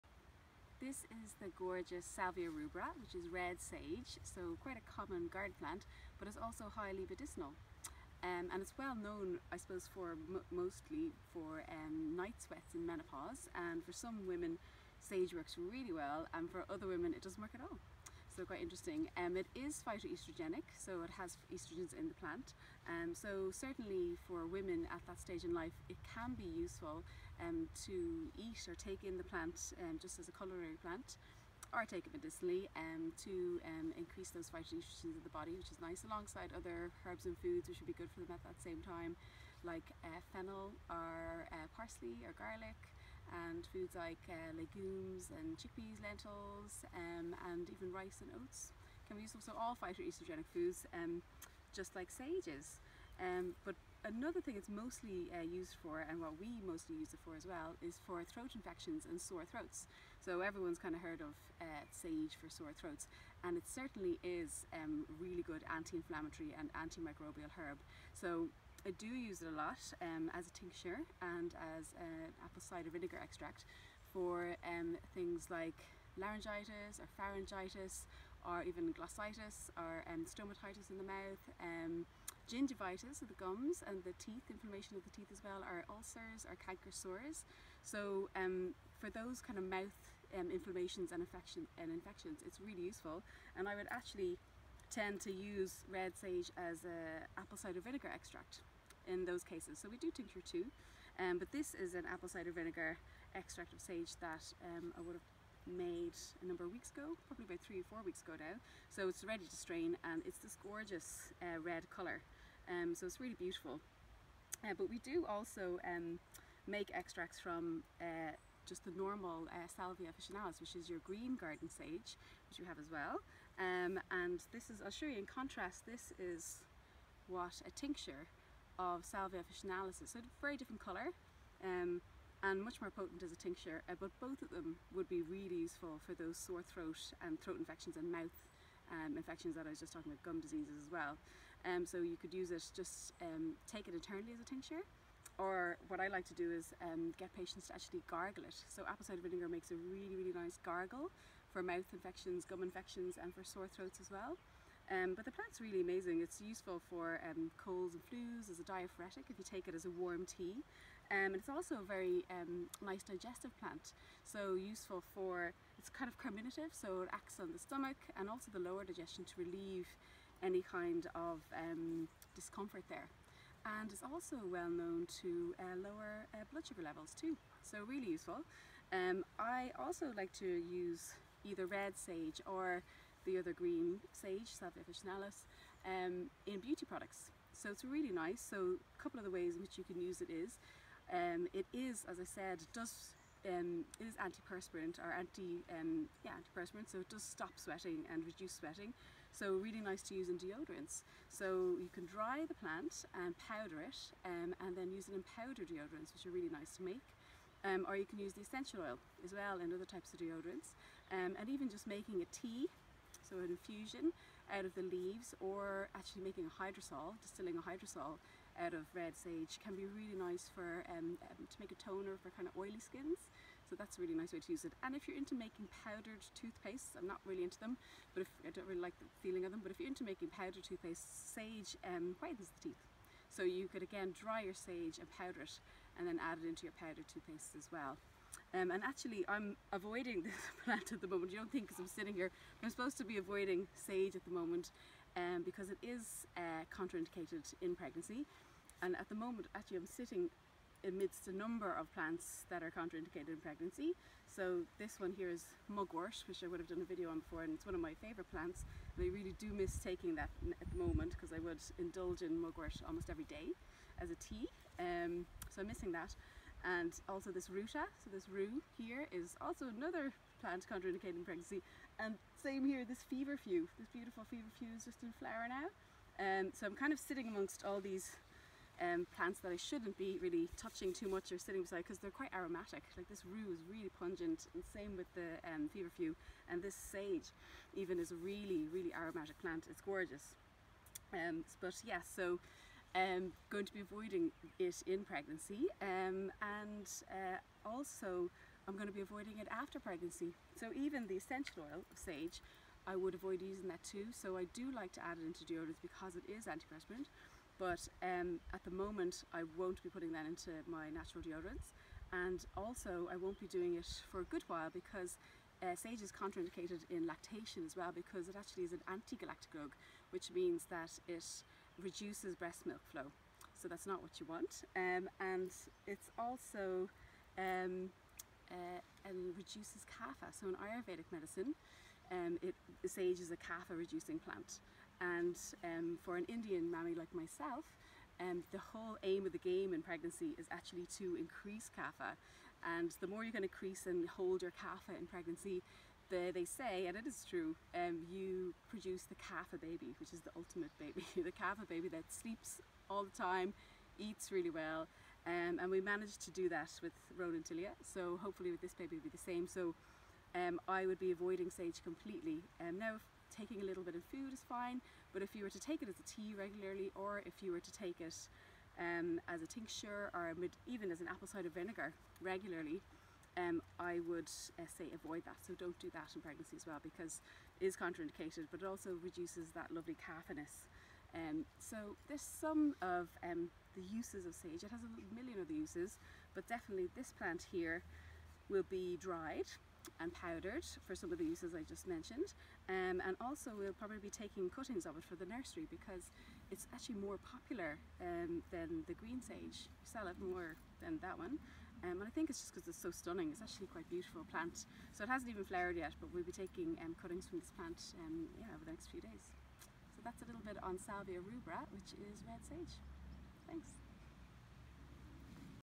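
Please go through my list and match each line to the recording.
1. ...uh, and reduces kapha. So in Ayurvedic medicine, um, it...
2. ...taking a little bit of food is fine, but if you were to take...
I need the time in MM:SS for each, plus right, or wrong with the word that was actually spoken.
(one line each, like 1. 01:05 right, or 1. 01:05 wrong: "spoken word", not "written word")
1. 05:28 right
2. 06:03 right.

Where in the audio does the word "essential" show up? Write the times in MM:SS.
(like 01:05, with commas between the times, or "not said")
03:28, 05:01.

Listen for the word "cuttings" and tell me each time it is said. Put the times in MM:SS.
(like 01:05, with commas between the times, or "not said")
06:34, 06:47.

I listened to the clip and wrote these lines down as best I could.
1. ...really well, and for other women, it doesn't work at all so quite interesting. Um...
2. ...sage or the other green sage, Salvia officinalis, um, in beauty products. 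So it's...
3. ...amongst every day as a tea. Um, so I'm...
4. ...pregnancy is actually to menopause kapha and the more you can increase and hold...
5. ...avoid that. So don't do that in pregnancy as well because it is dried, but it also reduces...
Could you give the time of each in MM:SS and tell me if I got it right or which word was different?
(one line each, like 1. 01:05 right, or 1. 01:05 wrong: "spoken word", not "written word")
1. 00:15 right
2. 03:01 right
3. 04:22 wrong: "almost", not "amongst"
4. 05:39 wrong: "increase", not "menopause"
5. 06:14 wrong: "contraindicated", not "dried".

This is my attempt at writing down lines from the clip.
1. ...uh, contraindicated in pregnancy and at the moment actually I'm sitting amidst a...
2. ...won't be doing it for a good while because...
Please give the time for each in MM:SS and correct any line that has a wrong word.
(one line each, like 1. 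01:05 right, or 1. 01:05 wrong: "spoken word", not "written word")
1. 04:06 right
2. 05:13 right.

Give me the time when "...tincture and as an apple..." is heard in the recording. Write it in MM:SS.
01:10.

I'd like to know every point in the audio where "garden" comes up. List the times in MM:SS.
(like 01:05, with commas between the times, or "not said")
00:05, 02:01.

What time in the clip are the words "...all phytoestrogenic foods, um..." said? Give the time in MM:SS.
00:49.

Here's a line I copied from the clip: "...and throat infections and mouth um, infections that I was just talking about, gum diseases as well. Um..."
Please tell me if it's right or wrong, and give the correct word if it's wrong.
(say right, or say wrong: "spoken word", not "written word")
right.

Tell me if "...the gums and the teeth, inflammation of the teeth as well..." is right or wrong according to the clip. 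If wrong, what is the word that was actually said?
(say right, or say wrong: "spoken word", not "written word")
right.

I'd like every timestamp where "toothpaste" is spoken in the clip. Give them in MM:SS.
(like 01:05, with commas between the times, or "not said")
03:46, 03:50, 03:57.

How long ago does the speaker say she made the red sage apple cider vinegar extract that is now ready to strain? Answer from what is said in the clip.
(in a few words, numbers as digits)
3 or 4 weeks.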